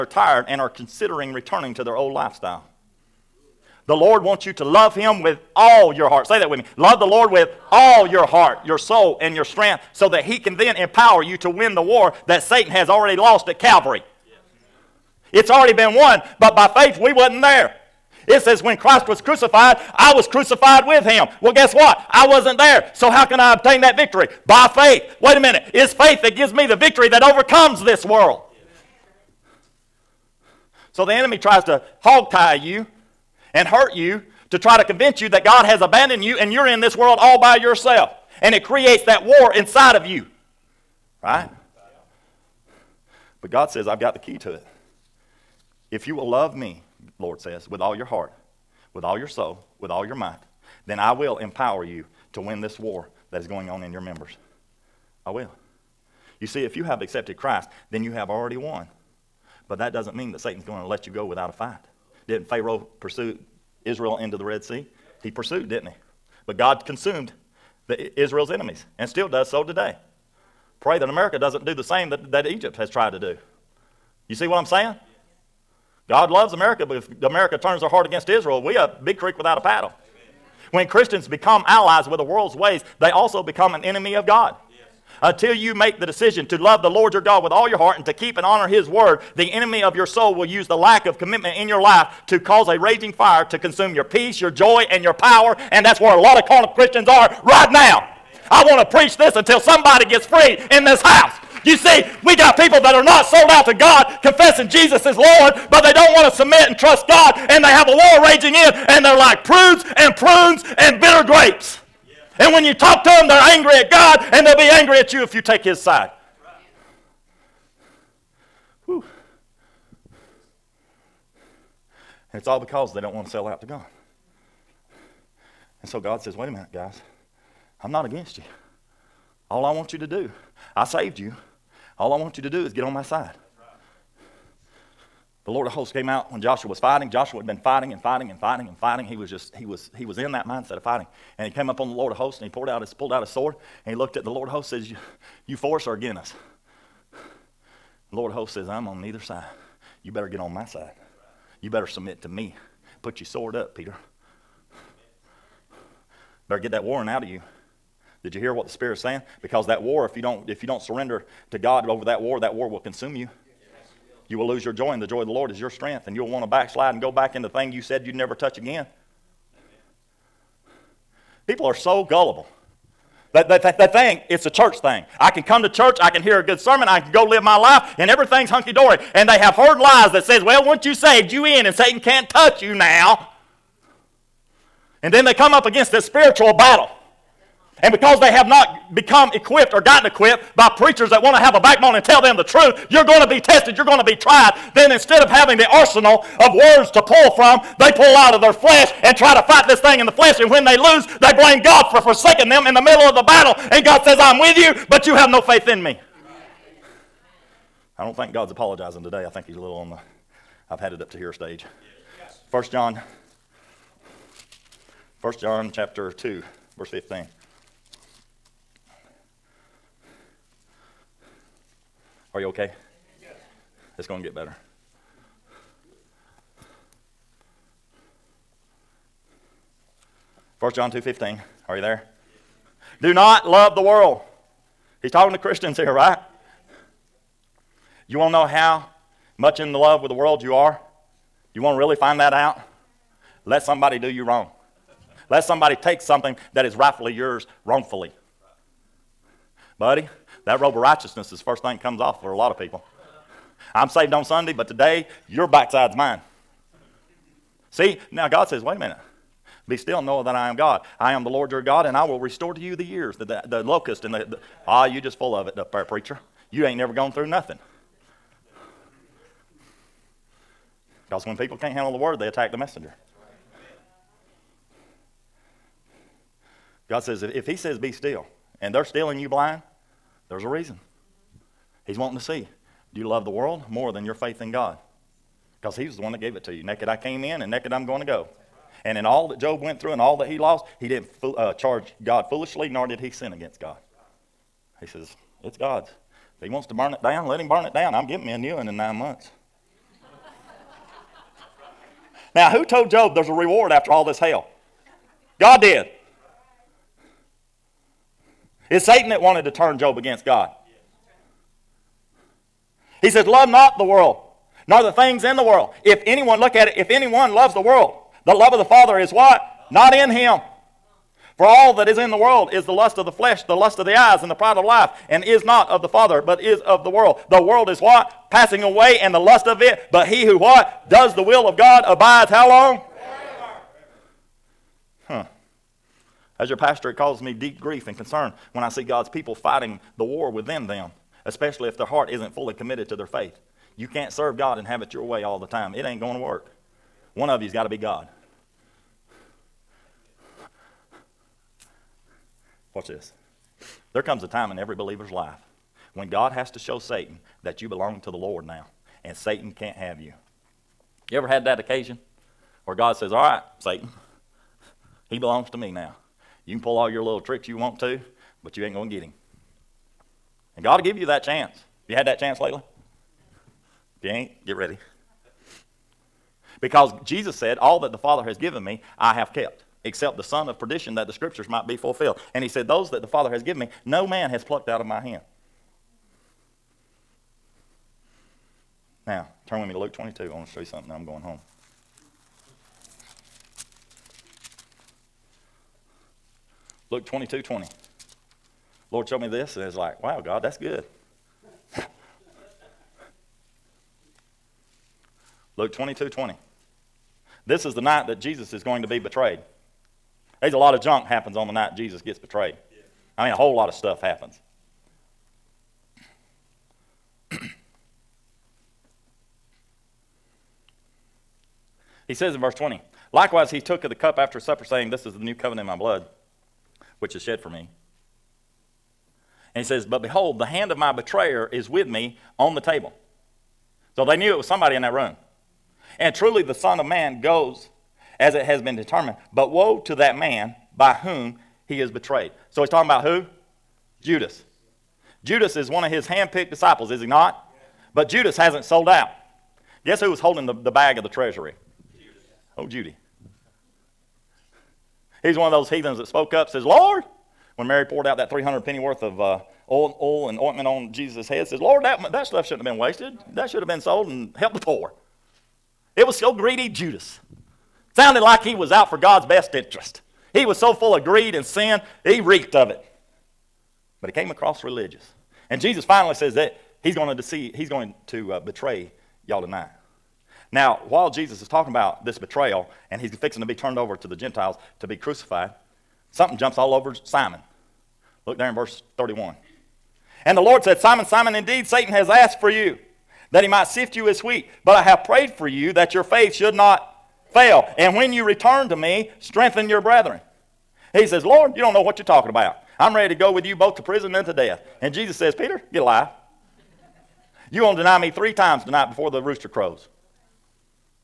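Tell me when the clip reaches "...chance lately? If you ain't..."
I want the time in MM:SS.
06:12.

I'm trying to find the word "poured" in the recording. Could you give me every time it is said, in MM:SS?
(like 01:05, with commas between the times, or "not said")
02:22, 07:37.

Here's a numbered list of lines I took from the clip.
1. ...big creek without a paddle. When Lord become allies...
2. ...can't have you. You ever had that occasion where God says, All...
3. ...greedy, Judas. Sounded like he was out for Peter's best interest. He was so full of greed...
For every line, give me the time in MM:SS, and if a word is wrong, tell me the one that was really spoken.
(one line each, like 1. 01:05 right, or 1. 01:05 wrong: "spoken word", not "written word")
1. 01:19 wrong: "Christians", not "Lord"
2. 05:59 right
3. 07:46 wrong: "God", not "Peter".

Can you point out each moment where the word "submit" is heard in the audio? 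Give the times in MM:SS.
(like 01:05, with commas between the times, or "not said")
01:46, 02:31.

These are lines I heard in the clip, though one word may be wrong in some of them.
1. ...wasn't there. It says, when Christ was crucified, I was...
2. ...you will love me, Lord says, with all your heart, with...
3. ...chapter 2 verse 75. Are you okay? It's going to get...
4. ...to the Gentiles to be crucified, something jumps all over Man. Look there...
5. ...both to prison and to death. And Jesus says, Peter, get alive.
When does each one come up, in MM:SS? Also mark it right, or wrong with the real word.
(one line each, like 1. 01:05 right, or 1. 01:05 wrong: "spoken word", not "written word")
1. 00:17 right
2. 00:46 right
3. 03:35 wrong: "15", not "75"
4. 08:03 wrong: "Simon", not "Man"
5. 08:23 right.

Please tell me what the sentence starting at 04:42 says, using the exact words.
Do you love the world more than your faith in God?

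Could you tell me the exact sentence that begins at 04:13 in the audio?
I'm saved on Sunday, but today your backside's mine.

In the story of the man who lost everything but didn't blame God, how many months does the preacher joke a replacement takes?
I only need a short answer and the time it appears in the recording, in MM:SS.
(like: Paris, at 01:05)
9, at 04:58.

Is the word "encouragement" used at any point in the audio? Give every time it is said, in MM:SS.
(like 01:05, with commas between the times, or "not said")
not said.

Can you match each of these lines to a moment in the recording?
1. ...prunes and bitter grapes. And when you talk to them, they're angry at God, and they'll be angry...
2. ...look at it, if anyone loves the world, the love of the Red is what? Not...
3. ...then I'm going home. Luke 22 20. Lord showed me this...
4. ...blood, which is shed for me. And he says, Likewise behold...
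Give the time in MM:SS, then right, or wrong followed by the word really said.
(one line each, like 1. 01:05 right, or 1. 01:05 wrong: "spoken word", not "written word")
1. 01:50 right
2. 05:16 wrong: "Father", not "Red"
3. 06:30 right
4. 07:05 wrong: "But", not "Likewise".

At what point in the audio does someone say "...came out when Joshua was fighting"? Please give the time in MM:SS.
02:15.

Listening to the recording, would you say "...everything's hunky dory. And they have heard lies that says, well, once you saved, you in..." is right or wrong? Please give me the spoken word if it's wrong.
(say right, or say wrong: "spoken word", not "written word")
right.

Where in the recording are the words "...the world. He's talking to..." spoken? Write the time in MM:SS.
03:53.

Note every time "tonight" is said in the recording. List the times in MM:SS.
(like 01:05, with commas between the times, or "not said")
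07:59, 08:28.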